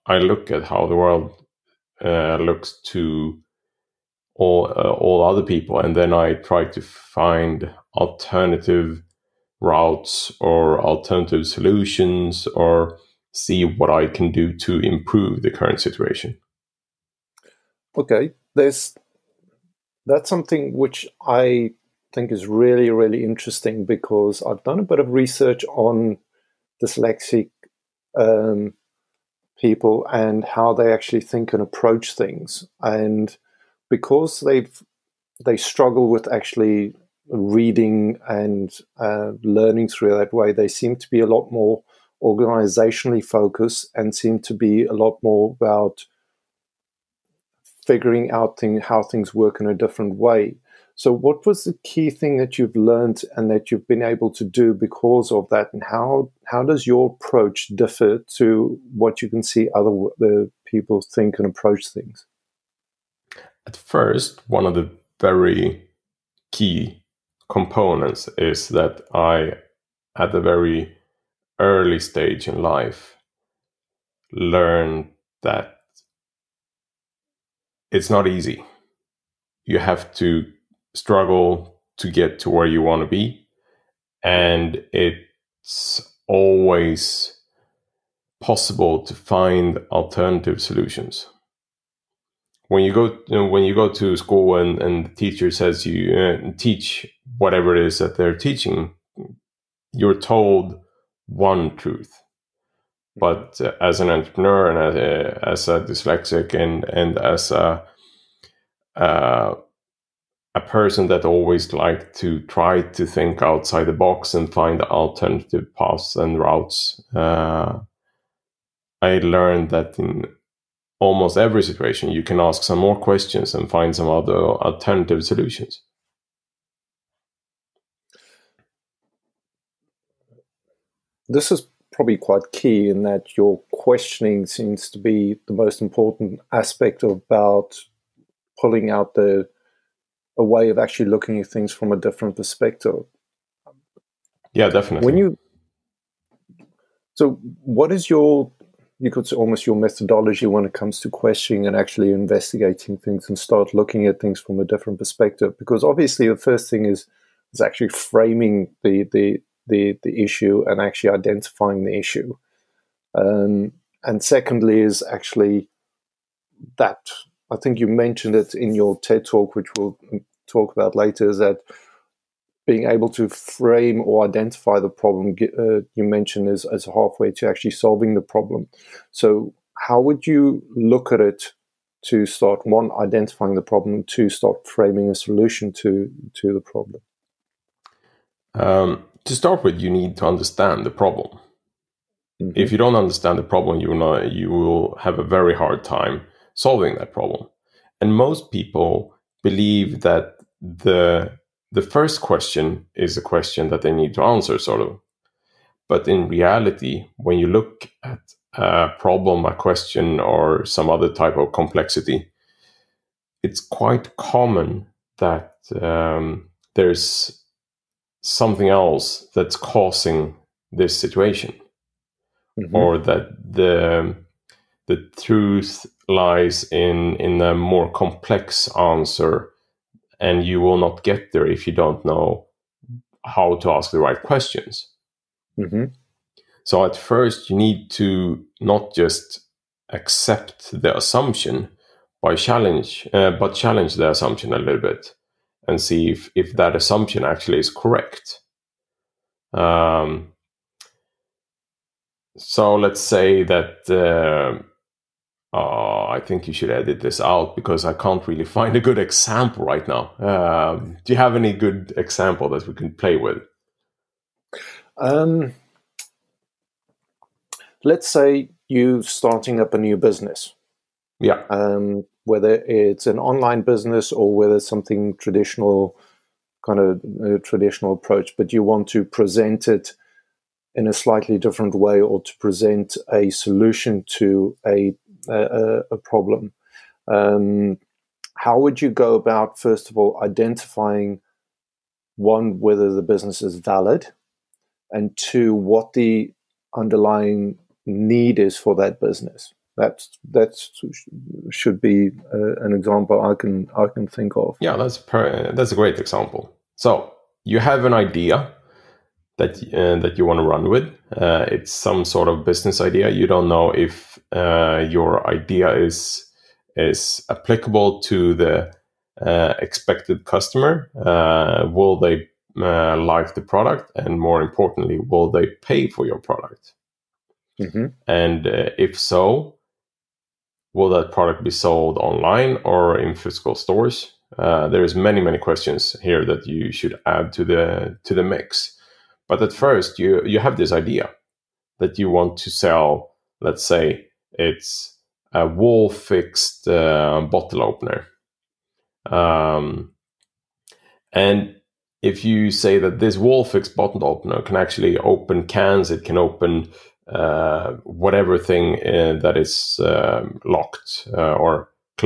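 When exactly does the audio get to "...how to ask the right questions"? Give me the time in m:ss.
3:53.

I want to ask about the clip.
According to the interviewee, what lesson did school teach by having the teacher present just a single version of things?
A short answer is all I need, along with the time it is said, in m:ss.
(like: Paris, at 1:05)
one truth, at 1:41.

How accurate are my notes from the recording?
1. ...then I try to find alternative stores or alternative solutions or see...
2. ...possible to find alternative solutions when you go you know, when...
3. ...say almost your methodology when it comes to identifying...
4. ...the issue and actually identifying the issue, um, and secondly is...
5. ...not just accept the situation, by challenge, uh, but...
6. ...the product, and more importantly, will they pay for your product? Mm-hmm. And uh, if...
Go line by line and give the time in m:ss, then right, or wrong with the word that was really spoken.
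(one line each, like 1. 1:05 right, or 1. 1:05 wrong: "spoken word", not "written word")
1. 0:05 wrong: "routes", not "stores"
2. 1:28 right
3. 2:29 wrong: "questioning", not "identifying"
4. 2:40 right
5. 3:58 wrong: "assumption", not "situation"
6. 5:23 right.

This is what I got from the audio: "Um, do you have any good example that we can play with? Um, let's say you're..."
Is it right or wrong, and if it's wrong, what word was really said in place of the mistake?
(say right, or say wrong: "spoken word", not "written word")
right.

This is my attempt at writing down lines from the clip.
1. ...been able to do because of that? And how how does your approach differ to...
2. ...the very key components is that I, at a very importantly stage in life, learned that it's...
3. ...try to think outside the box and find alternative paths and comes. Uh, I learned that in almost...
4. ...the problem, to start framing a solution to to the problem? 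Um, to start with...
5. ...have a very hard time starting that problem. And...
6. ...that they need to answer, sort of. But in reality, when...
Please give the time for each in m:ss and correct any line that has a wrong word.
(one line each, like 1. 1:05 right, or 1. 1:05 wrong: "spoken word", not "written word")
1. 0:53 right
2. 1:04 wrong: "early", not "importantly"
3. 1:52 wrong: "routes", not "comes"
4. 3:03 right
5. 3:14 wrong: "solving", not "starting"
6. 3:23 right.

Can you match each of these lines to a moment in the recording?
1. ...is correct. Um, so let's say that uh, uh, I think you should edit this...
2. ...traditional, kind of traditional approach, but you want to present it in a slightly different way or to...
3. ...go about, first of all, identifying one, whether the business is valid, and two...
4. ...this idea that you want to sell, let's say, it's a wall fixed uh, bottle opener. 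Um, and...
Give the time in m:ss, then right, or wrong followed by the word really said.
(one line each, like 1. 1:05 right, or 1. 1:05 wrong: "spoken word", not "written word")
1. 4:07 right
2. 4:35 right
3. 4:48 right
4. 5:40 right.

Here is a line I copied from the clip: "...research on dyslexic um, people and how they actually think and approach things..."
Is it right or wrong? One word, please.
right.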